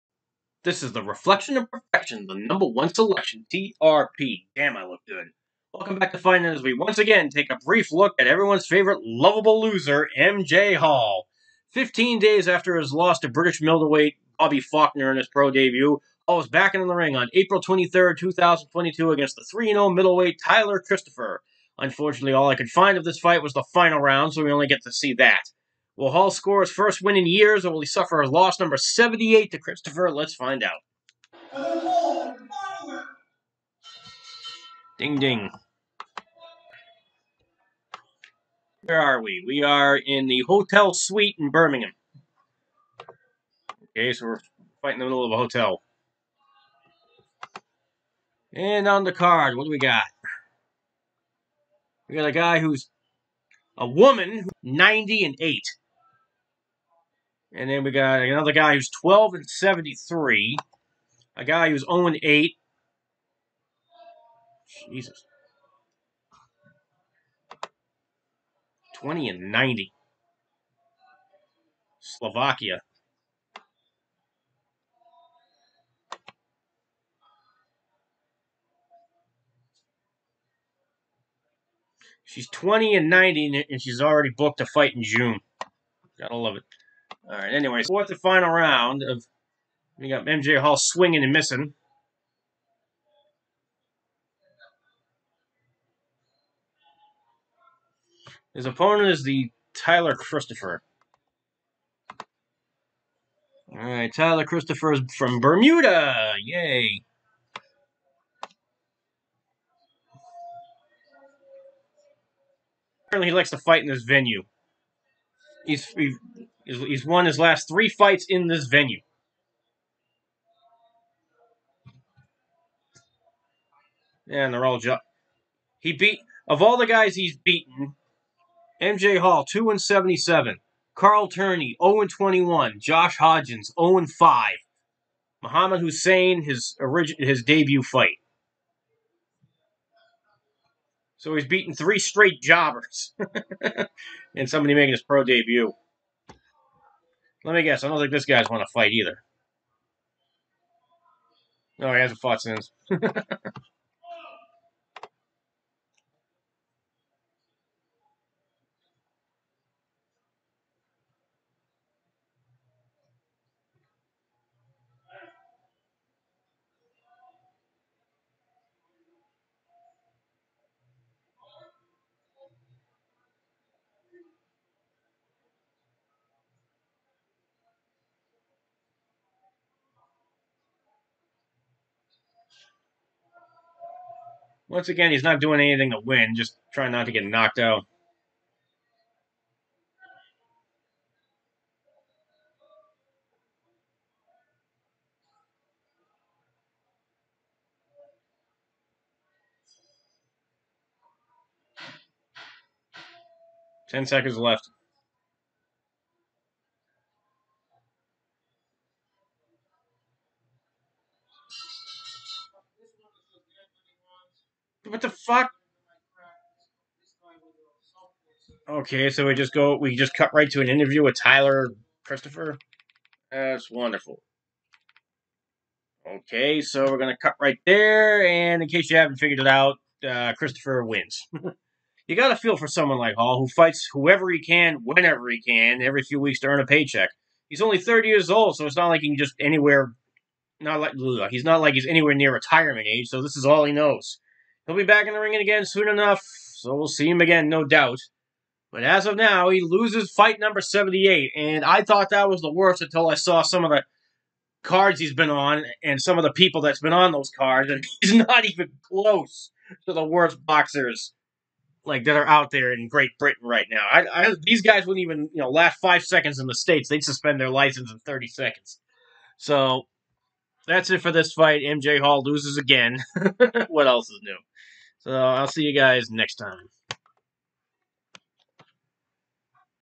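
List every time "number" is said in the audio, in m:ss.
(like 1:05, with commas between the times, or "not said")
0:02, 0:28, 4:10.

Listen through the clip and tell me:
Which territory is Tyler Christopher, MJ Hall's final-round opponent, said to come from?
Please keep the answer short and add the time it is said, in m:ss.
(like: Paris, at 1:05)
Bermuda, at 1:45.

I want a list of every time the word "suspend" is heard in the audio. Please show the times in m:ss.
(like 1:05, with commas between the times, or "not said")
4:27.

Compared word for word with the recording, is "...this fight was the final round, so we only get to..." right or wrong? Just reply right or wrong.
right.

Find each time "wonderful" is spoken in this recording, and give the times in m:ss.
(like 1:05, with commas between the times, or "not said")
3:43.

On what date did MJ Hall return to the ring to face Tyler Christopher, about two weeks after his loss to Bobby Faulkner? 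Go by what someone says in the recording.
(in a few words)
April 23, 2022.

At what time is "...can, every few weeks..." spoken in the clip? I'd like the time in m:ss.
3:55.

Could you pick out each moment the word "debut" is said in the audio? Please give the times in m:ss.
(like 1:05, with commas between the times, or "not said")
0:15, 2:17, 2:25.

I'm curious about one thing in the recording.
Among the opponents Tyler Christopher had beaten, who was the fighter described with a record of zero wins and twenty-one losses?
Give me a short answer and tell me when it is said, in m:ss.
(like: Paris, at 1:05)
Carl Turney, at 2:10.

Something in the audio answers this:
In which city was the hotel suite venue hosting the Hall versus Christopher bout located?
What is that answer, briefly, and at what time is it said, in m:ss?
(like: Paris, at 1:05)
Birmingham, at 0:41.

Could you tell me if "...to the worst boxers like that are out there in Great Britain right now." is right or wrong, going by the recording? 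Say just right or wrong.
right.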